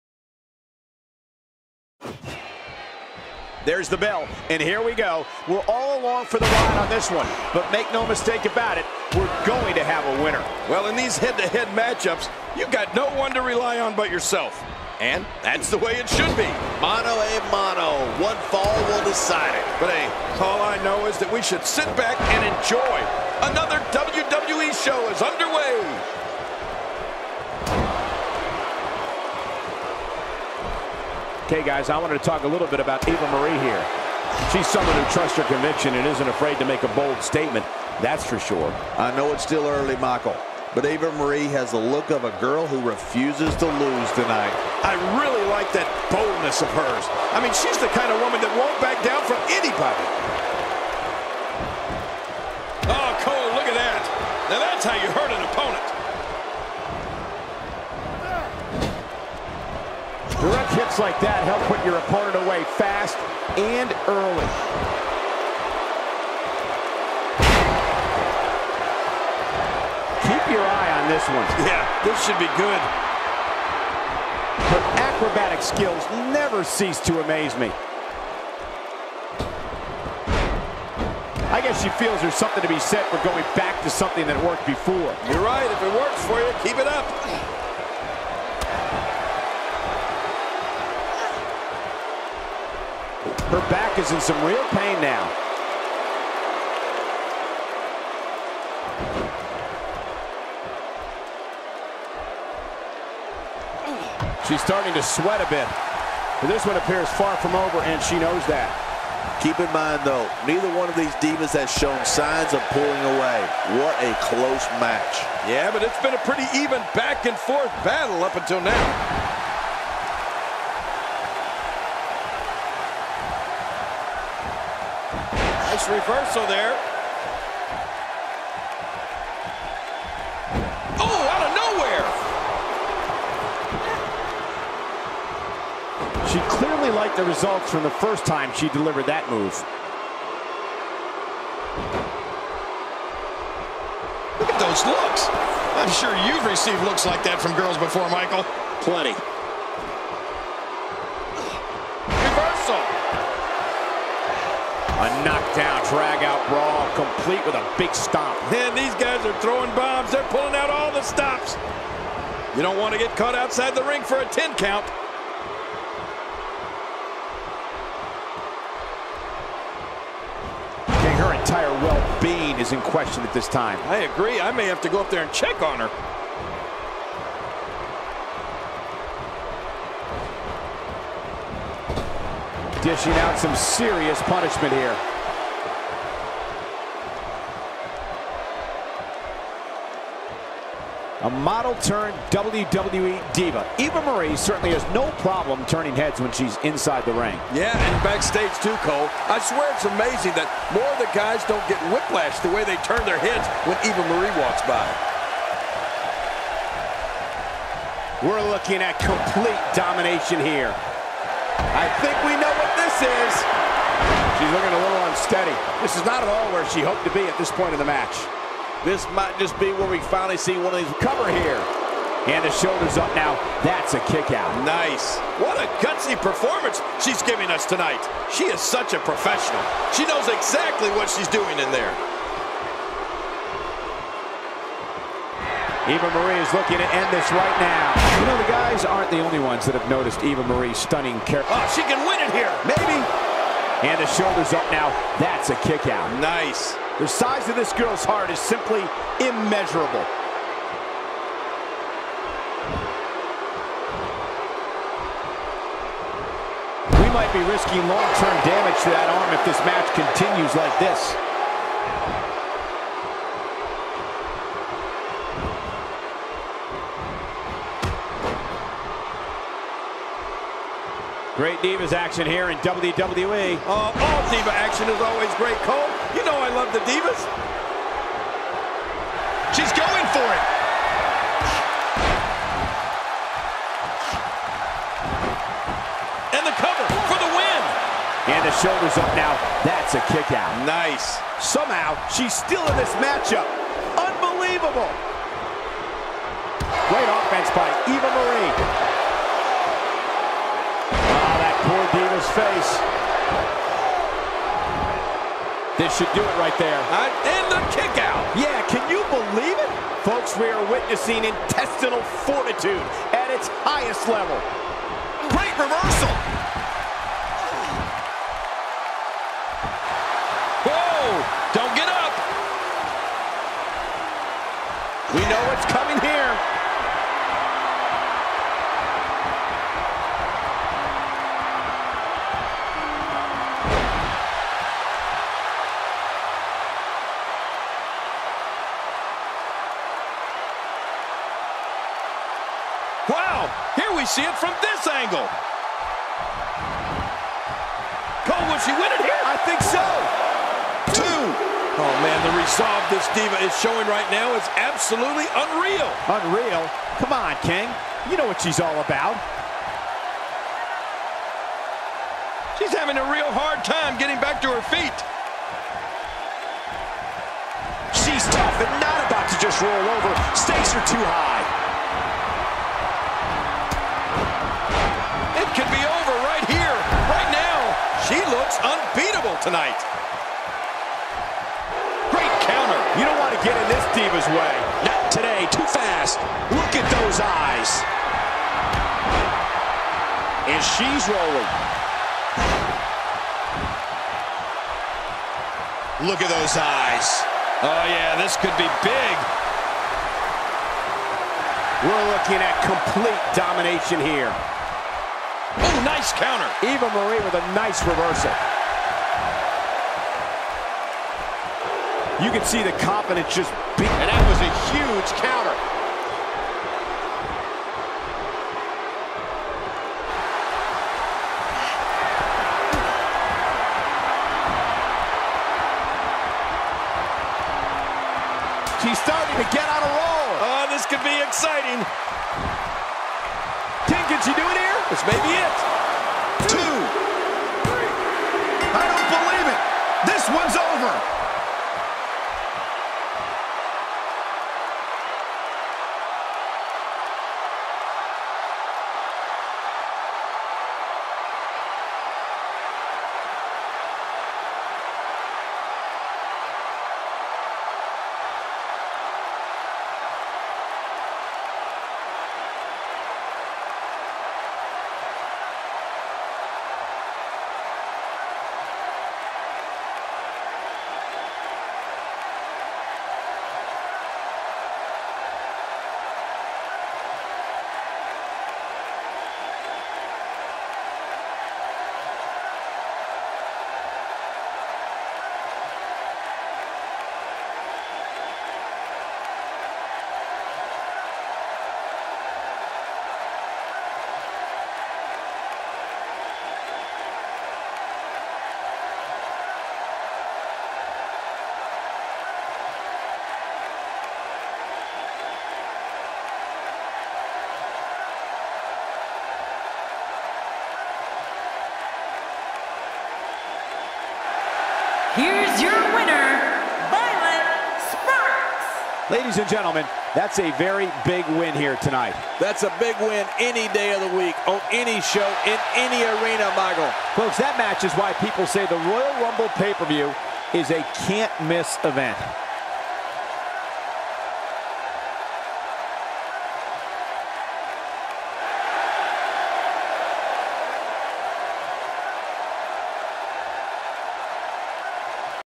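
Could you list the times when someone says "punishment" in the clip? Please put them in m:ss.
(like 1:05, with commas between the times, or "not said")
3:04.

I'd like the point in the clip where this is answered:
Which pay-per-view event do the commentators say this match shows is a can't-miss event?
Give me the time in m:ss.
8:48.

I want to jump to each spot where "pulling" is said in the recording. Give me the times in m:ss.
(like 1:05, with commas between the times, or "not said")
1:52, 2:40.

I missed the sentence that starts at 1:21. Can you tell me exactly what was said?
I guess she feels there's something to be said for going back to something that worked before.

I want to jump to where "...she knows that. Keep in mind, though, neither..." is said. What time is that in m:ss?
1:48.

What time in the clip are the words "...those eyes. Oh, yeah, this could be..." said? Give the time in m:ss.
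6:36.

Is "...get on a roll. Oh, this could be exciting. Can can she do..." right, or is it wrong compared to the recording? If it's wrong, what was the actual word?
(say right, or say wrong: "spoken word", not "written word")
right.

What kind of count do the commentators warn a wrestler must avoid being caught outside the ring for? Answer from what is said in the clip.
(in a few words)
10 count.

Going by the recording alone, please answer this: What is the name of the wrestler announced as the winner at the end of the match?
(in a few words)
Violet Sparks.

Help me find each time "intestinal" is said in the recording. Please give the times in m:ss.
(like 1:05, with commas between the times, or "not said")
5:11.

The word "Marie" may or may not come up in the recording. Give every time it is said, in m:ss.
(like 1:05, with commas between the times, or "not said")
0:33, 0:41, 3:14, 3:24, 3:56, 4:00, 4:58, 6:46.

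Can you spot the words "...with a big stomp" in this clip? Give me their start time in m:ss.
2:37.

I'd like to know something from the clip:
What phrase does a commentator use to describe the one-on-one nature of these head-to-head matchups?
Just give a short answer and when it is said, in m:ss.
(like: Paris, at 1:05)
Mono a mono, at 0:16.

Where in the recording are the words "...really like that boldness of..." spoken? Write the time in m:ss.
0:45.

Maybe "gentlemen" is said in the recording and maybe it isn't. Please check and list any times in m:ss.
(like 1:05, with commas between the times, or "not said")
8:39.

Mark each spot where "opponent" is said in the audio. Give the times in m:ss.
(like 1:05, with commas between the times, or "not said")
0:55, 1:01.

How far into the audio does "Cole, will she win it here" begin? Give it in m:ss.
5:48.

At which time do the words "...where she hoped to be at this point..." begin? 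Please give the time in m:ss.
3:36.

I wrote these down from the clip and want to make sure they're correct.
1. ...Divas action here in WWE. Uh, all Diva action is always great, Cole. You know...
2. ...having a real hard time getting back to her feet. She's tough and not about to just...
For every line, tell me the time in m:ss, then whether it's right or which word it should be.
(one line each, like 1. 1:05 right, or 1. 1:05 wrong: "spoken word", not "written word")
1. 4:31 right
2. 6:02 right.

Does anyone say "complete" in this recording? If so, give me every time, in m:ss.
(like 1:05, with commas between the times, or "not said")
2:36, 3:28, 6:42.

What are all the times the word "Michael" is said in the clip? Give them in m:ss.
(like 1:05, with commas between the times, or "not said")
0:39, 2:28, 8:46.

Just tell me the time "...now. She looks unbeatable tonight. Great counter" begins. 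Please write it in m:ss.
6:17.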